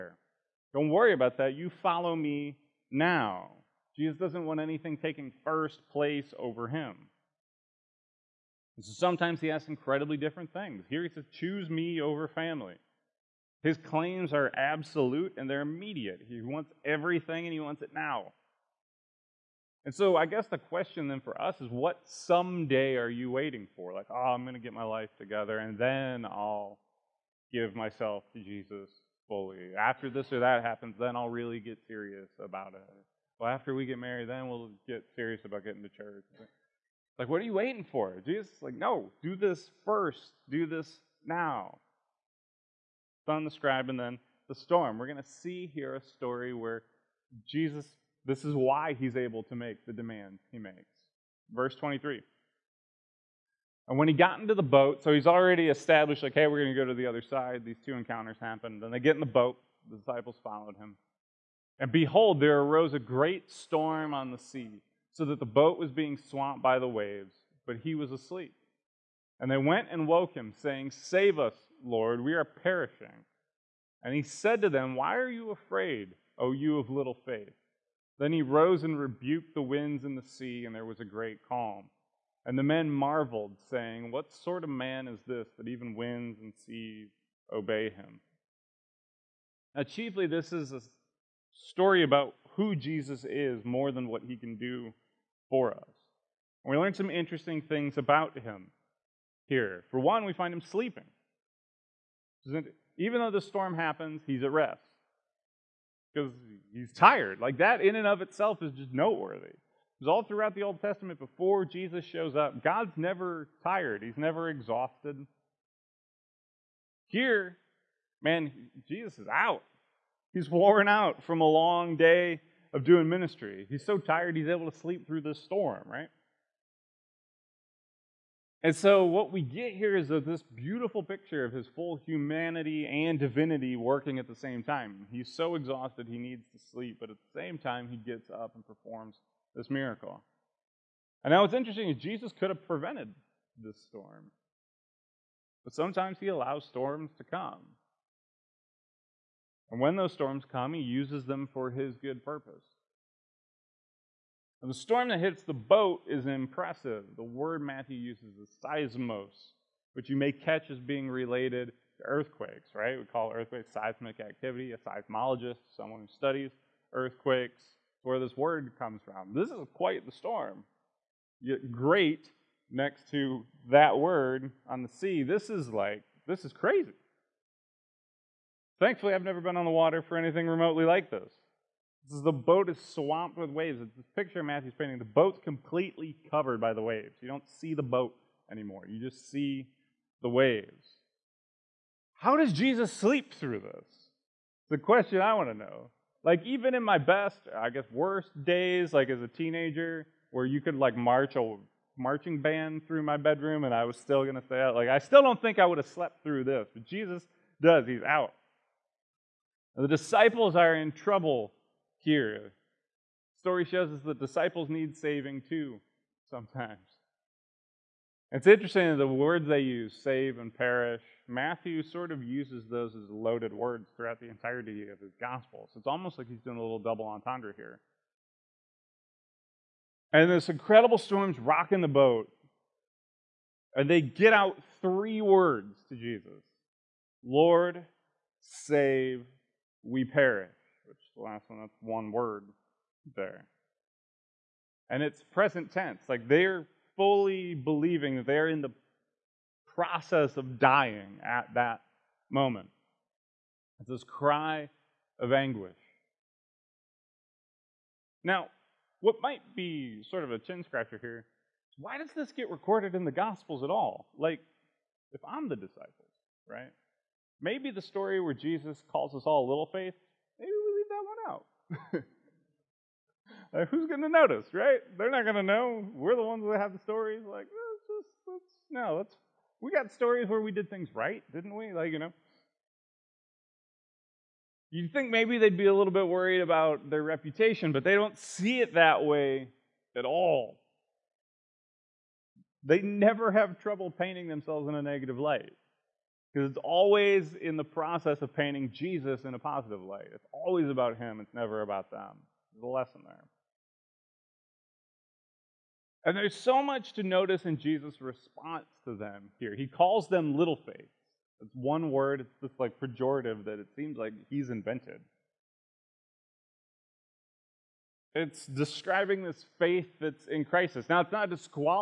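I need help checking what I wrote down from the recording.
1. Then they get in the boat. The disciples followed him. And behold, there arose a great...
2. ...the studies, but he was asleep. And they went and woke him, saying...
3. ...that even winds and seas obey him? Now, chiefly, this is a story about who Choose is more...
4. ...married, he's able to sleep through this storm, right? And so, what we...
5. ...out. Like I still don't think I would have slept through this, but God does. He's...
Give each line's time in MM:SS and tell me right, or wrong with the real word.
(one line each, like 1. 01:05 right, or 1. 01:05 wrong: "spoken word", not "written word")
1. 00:58 right
2. 01:06 wrong: "waves", not "studies"
3. 01:25 wrong: "Jesus", not "Choose"
4. 02:03 wrong: "tired", not "married"
5. 03:24 wrong: "Jesus", not "God".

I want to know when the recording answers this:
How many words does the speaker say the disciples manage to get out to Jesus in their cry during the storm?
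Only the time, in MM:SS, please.
03:54.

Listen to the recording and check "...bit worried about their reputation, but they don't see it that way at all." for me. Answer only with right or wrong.
right.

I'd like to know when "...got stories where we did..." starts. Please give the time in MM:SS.
04:39.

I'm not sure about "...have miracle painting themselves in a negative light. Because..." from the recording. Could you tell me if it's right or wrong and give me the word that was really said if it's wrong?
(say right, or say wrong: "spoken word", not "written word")
wrong: "trouble", not "miracle".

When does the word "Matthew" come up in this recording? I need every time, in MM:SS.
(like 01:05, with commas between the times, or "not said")
02:37, 03:04, 03:41.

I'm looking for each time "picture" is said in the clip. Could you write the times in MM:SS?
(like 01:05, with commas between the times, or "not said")
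02:11, 03:04.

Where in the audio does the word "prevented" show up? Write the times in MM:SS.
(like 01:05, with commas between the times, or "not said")
02:22.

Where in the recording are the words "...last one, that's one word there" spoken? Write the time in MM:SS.
04:01.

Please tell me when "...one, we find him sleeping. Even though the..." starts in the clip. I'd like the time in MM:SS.
01:39.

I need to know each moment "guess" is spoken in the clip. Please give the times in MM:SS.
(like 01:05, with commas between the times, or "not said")
00:20, 03:17.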